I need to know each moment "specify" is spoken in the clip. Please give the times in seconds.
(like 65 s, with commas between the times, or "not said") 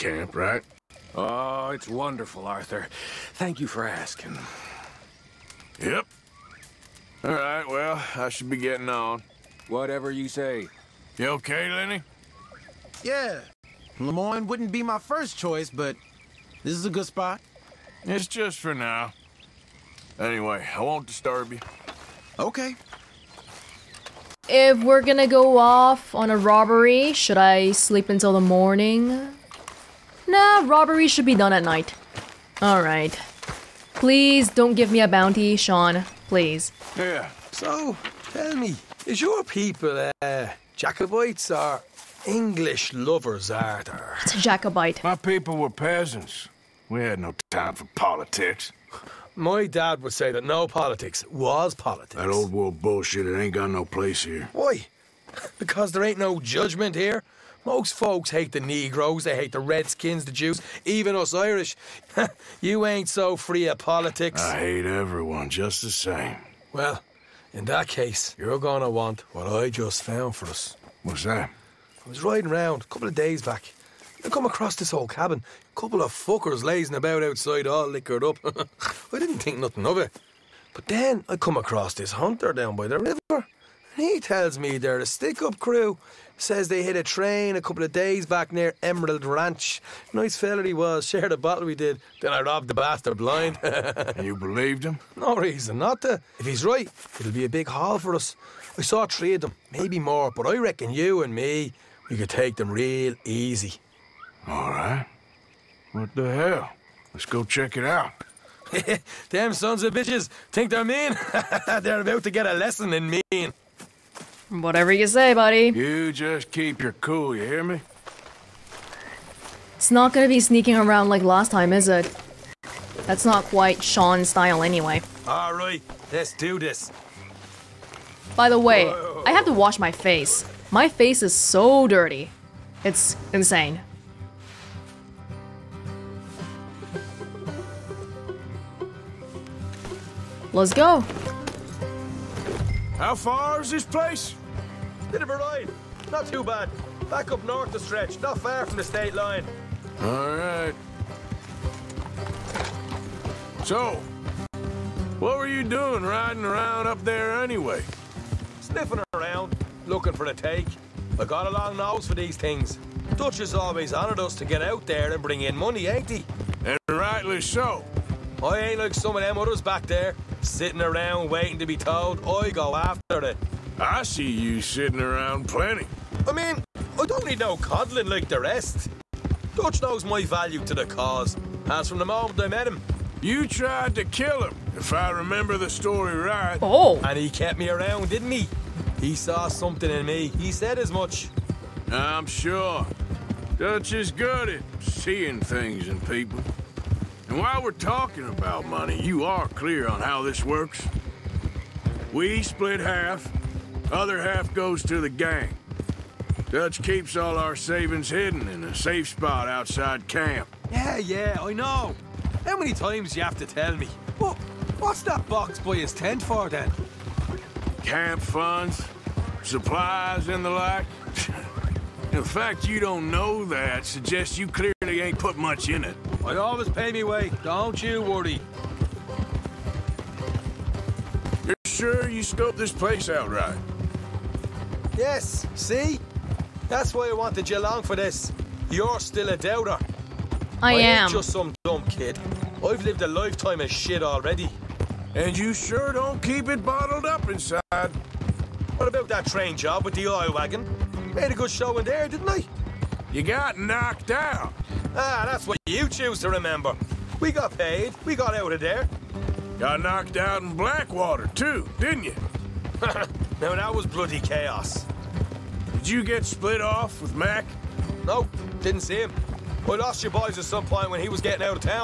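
not said.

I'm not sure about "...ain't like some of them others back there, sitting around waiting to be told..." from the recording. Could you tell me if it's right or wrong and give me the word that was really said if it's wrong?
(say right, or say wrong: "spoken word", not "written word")
right.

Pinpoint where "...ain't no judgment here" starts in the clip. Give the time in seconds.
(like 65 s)
56 s.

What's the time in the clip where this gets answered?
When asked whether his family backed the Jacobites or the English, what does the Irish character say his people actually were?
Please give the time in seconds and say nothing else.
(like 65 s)
45 s.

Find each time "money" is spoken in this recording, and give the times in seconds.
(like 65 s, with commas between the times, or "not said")
165 s, 198 s.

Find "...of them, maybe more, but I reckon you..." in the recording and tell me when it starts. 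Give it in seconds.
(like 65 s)
99 s.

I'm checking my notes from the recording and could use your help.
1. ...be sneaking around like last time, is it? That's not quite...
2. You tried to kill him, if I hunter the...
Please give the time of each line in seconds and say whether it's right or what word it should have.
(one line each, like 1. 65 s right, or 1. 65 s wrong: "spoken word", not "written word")
1. 120 s right
2. 183 s wrong: "remember", not "hunter".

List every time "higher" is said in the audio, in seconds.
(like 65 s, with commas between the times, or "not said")
not said.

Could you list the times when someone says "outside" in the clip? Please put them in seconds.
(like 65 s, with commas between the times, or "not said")
77 s, 209 s.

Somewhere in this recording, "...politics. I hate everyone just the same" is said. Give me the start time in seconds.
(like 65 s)
63 s.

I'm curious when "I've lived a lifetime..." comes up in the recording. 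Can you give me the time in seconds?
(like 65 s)
242 s.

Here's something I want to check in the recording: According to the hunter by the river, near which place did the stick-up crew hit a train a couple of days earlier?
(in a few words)
Emerald Ranch.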